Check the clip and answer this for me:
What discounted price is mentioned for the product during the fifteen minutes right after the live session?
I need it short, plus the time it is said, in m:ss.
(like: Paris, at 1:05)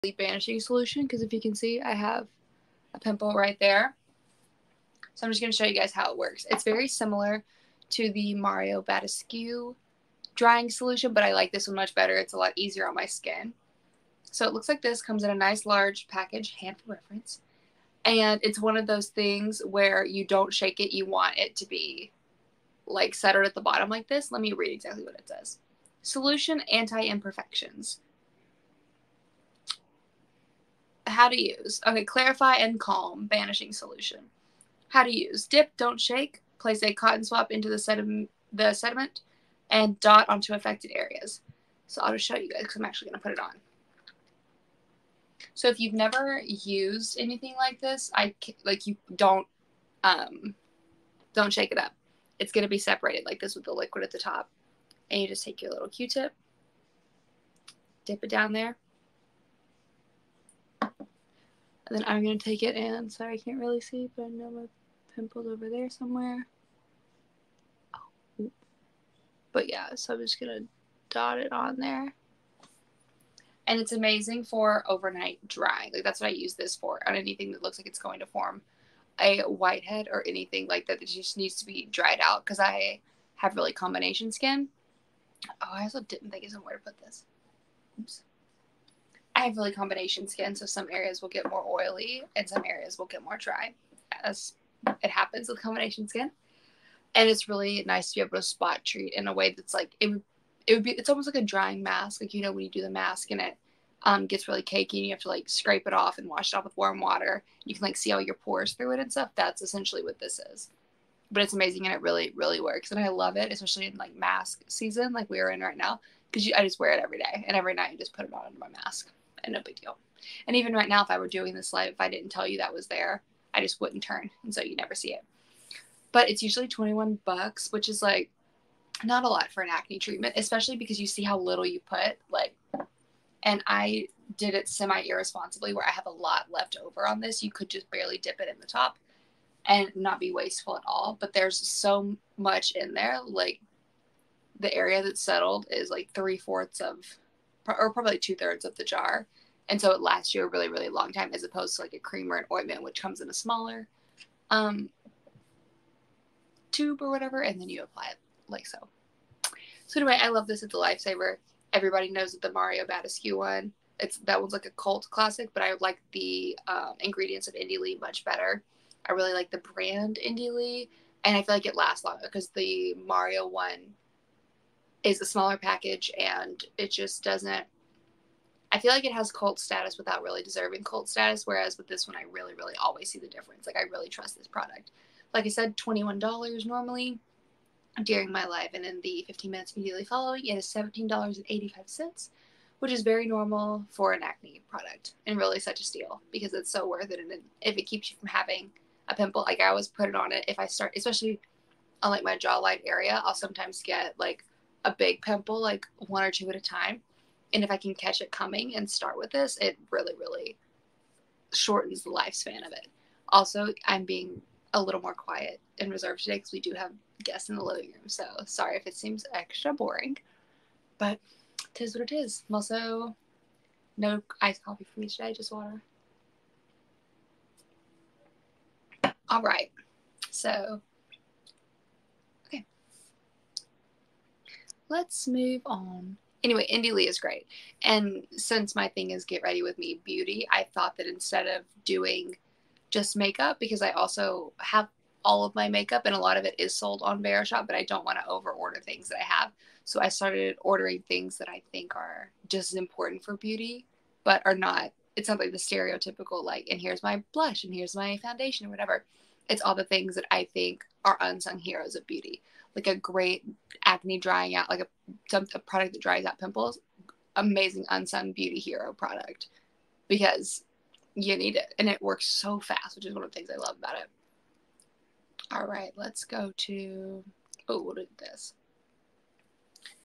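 $17.85, at 3:10.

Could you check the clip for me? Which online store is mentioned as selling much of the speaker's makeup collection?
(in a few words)
Verishop.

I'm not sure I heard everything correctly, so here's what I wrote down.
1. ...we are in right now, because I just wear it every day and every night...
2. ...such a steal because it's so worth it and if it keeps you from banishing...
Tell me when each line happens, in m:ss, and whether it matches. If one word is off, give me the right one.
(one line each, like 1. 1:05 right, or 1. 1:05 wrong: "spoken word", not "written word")
1. 1:55 right
2. 3:15 wrong: "having", not "banishing".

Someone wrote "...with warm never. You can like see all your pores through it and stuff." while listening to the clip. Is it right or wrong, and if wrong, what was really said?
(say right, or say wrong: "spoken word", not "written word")
wrong: "water", not "never".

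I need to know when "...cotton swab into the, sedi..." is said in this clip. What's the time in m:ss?
0:36.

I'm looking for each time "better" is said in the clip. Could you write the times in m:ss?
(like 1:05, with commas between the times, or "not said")
0:11, 2:48.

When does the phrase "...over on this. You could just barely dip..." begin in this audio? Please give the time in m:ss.
2:16.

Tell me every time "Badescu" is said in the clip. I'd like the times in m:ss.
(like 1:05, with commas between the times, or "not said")
0:08, 2:42.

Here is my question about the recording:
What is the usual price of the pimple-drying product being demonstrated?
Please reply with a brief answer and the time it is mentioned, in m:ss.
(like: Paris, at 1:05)
$21, at 2:06.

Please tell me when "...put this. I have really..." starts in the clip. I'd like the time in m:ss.
1:26.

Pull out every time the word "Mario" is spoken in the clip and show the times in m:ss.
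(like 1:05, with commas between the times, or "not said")
0:08, 2:42, 2:53.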